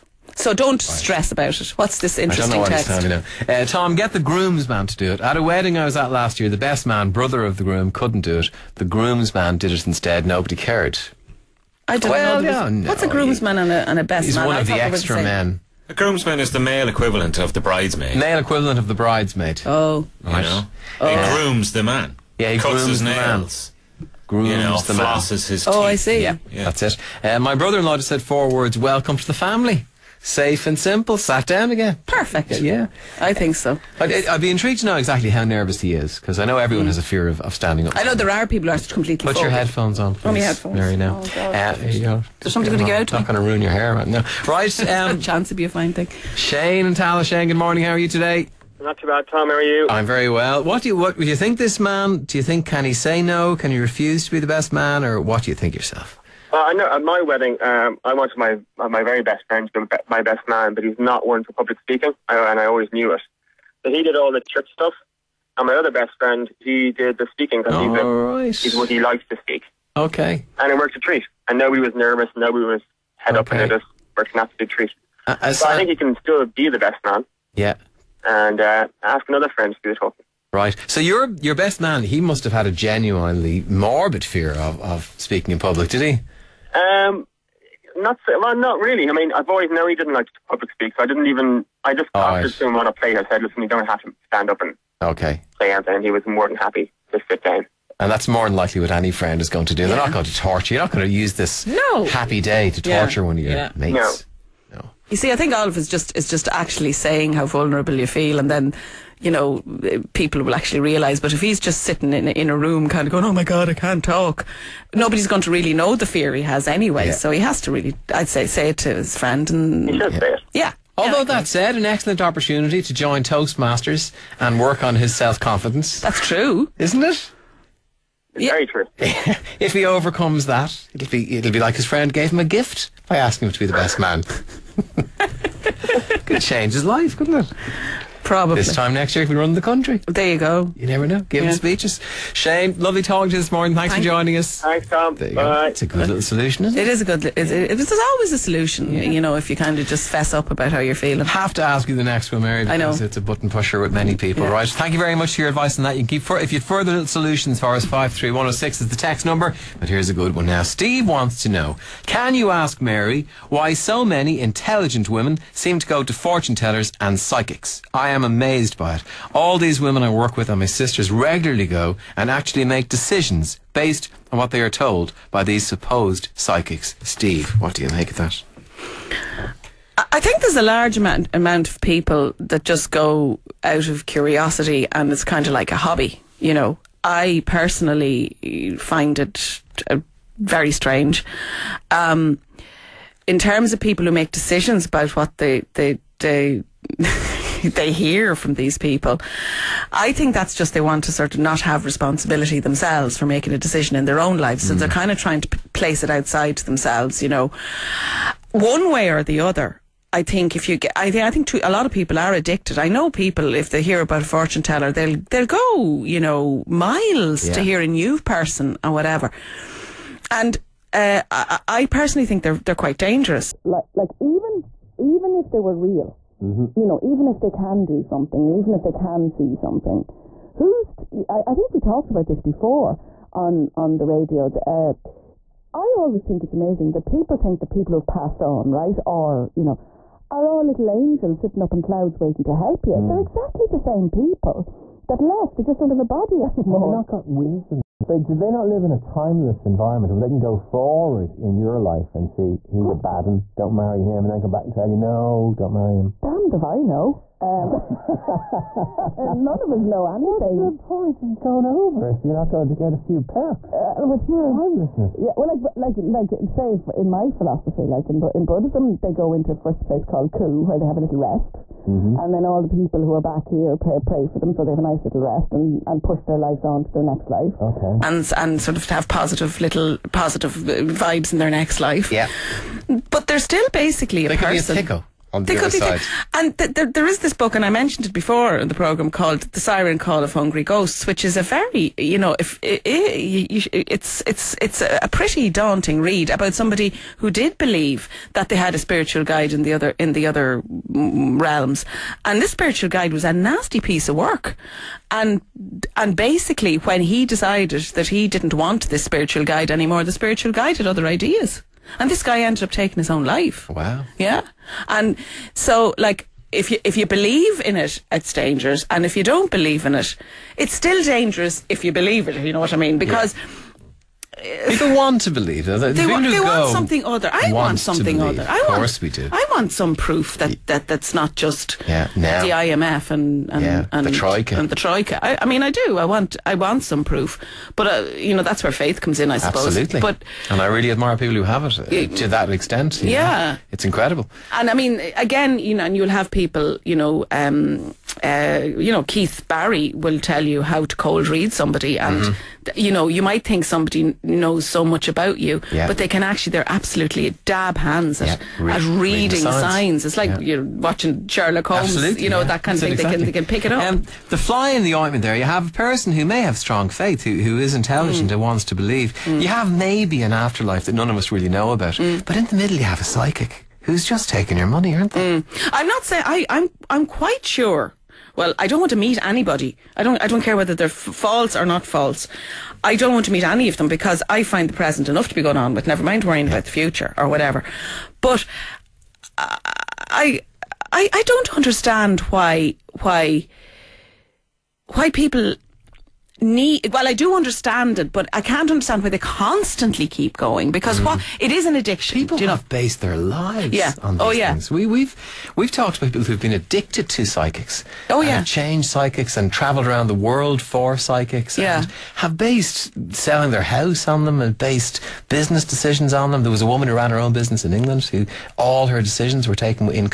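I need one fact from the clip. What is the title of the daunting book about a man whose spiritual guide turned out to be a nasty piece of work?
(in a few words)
The Siren Call of Hungry Ghosts.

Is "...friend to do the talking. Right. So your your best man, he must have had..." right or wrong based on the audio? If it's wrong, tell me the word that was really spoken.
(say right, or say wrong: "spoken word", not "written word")
right.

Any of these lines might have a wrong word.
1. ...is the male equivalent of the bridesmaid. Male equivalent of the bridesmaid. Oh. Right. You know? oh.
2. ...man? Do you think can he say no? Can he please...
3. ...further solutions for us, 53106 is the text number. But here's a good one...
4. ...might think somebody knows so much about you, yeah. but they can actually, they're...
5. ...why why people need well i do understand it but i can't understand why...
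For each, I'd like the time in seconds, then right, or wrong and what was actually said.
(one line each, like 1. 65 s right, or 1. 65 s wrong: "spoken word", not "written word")
1. 16 s right
2. 51 s wrong: "refuse", not "please"
3. 156 s right
4. 353 s right
5. 393 s right.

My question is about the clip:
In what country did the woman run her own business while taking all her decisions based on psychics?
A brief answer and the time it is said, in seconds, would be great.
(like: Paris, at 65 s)
England, at 417 s.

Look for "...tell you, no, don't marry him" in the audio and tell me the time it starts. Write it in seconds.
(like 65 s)
254 s.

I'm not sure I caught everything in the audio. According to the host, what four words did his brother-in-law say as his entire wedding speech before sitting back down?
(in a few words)
Welcome to the family.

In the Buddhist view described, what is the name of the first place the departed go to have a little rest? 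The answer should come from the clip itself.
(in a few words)
Ku.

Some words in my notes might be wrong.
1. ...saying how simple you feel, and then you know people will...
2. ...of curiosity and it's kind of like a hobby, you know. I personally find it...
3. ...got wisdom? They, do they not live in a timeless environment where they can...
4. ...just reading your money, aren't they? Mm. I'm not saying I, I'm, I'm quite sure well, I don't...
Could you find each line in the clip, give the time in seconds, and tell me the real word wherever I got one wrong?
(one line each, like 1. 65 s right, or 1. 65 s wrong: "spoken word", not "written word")
1. 106 s wrong: "vulnerable", not "simple"
2. 183 s right
3. 247 s right
4. 374 s wrong: "taking", not "reading".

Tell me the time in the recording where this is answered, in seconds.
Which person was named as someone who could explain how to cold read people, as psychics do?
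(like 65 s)
349 s.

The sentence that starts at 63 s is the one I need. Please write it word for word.
But he did all the church stuff, and my other best friend, he did the speaking because he's, right.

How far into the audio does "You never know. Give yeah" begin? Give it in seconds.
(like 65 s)
140 s.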